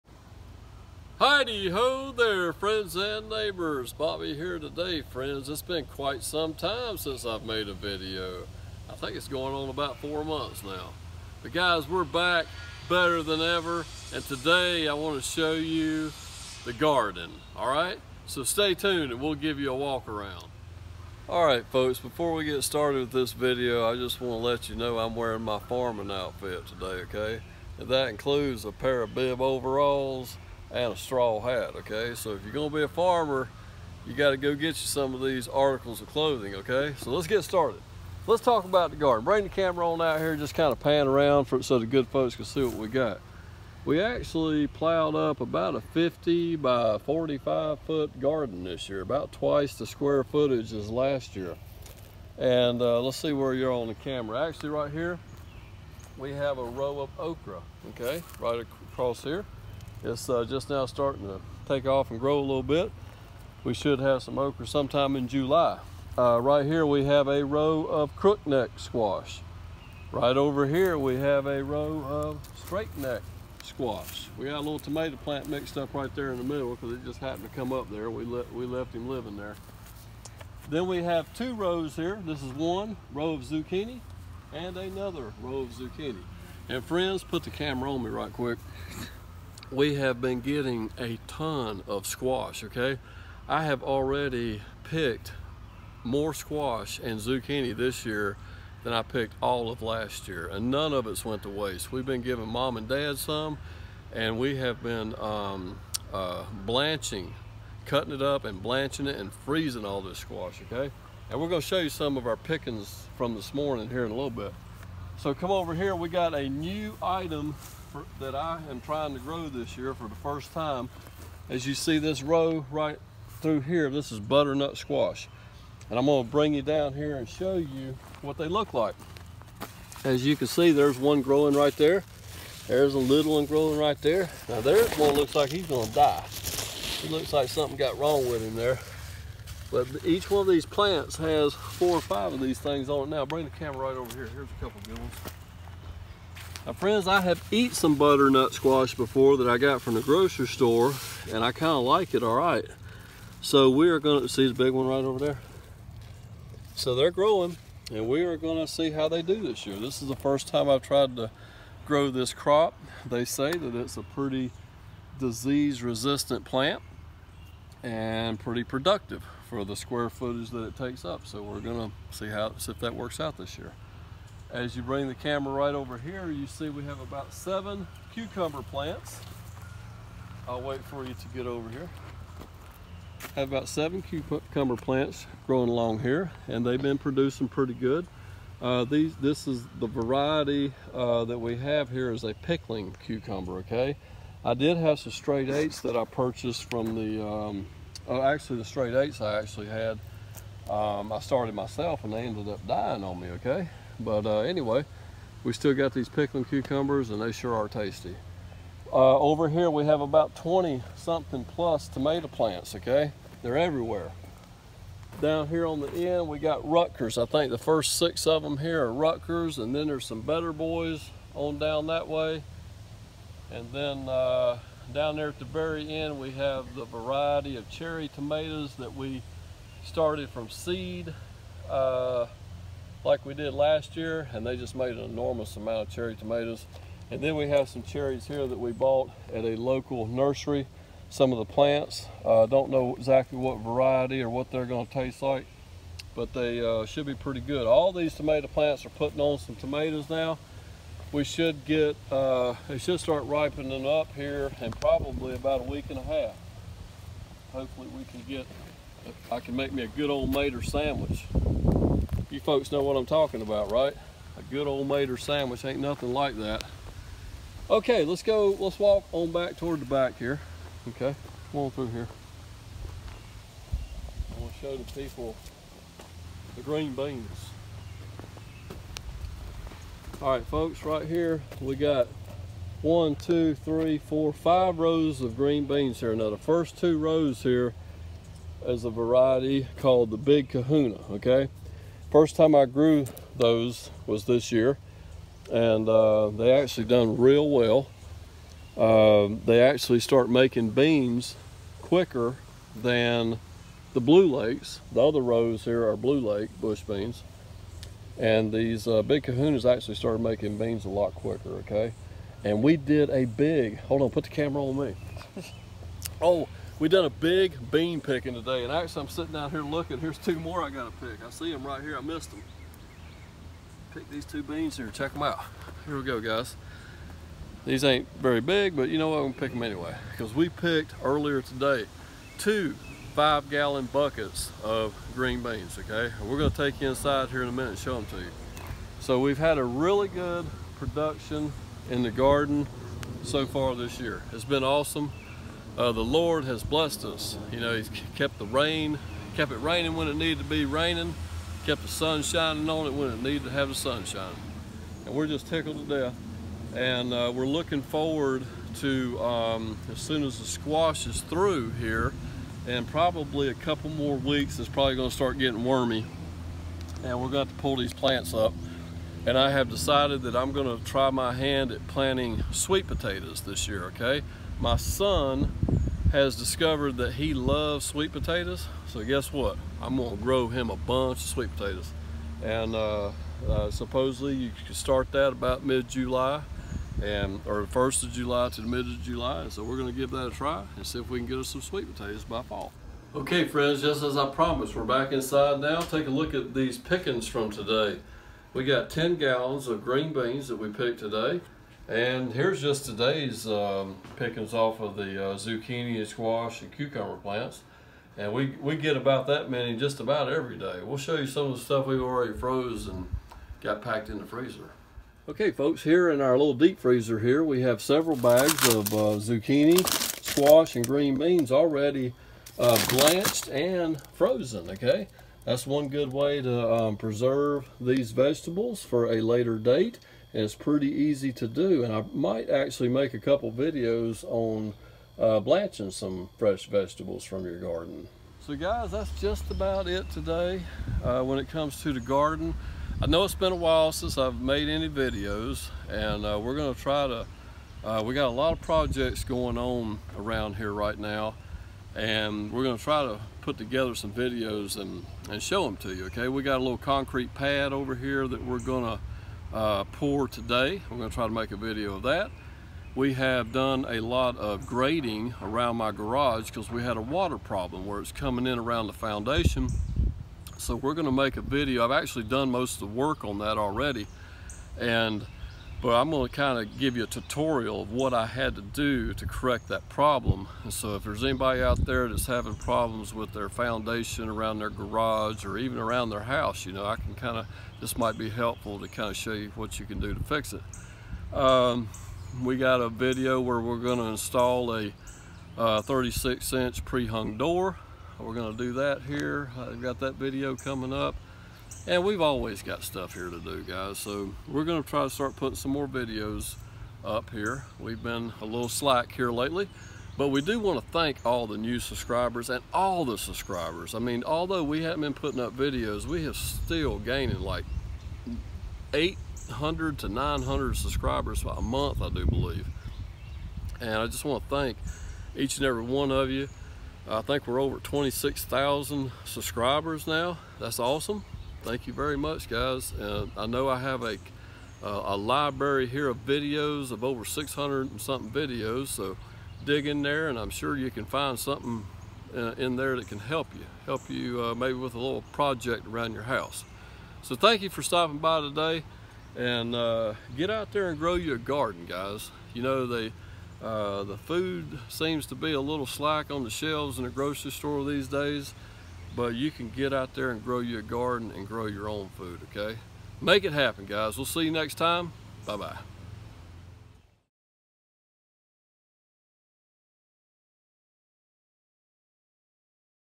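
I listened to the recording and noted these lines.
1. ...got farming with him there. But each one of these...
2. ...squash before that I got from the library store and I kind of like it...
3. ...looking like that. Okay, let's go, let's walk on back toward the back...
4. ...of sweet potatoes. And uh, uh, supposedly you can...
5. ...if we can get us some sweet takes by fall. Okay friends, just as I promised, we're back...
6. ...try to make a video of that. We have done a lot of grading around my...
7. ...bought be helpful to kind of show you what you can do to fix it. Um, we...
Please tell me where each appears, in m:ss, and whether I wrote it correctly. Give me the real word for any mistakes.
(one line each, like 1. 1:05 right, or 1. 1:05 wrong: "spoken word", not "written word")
1. 2:17 wrong: "wrong", not "farming"
2. 2:28 wrong: "grocery", not "library"
3. 4:25 wrong: "nothing", not "looking"
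4. 6:21 right
5. 6:30 wrong: "potatoes", not "takes"
6. 7:41 right
7. 8:07 wrong: "might", not "bought".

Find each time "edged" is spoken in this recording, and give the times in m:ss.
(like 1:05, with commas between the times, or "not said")
not said.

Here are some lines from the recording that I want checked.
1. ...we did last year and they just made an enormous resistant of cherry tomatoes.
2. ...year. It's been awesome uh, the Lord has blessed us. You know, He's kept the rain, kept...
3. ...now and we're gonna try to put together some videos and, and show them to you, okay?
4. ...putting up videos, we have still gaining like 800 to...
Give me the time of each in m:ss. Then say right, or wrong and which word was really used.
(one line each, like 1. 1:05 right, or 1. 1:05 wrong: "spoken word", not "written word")
1. 3:53 wrong: "amount", not "resistant"
2. 5:43 right
3. 7:30 right
4. 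8:35 right.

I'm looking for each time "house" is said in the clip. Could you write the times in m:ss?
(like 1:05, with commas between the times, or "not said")
8:06, 9:06.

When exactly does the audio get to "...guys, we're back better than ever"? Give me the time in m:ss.
0:11.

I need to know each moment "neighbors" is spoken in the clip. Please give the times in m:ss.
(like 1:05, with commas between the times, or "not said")
0:03.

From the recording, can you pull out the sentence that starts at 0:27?
And that includes a pair of bib overalls, and a straw hat, okay?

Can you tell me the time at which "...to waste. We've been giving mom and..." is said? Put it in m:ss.
1:41.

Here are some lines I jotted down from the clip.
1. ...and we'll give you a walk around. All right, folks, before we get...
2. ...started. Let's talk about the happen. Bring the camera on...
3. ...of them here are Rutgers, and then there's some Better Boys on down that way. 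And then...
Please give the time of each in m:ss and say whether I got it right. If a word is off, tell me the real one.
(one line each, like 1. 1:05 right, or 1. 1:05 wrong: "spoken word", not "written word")
1. 0:19 right
2. 0:37 wrong: "garden", not "happen"
3. 3:38 right.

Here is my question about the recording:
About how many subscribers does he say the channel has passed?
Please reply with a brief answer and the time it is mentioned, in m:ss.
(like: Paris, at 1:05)
26,000, at 8:47.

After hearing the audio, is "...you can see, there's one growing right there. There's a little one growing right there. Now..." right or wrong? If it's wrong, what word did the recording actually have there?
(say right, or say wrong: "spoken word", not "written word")
right.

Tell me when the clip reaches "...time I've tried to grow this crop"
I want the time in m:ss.
2:40.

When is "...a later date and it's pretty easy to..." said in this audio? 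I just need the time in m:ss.
7:09.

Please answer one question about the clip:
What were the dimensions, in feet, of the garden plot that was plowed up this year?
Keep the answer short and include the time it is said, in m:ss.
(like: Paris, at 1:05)
50 by 45 feet, at 0:45.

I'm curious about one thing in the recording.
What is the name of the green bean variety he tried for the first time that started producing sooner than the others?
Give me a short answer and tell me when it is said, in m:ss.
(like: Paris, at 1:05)
Big Kahuna, at 4:50.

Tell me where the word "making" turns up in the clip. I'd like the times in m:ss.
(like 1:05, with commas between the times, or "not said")
5:00, 5:10.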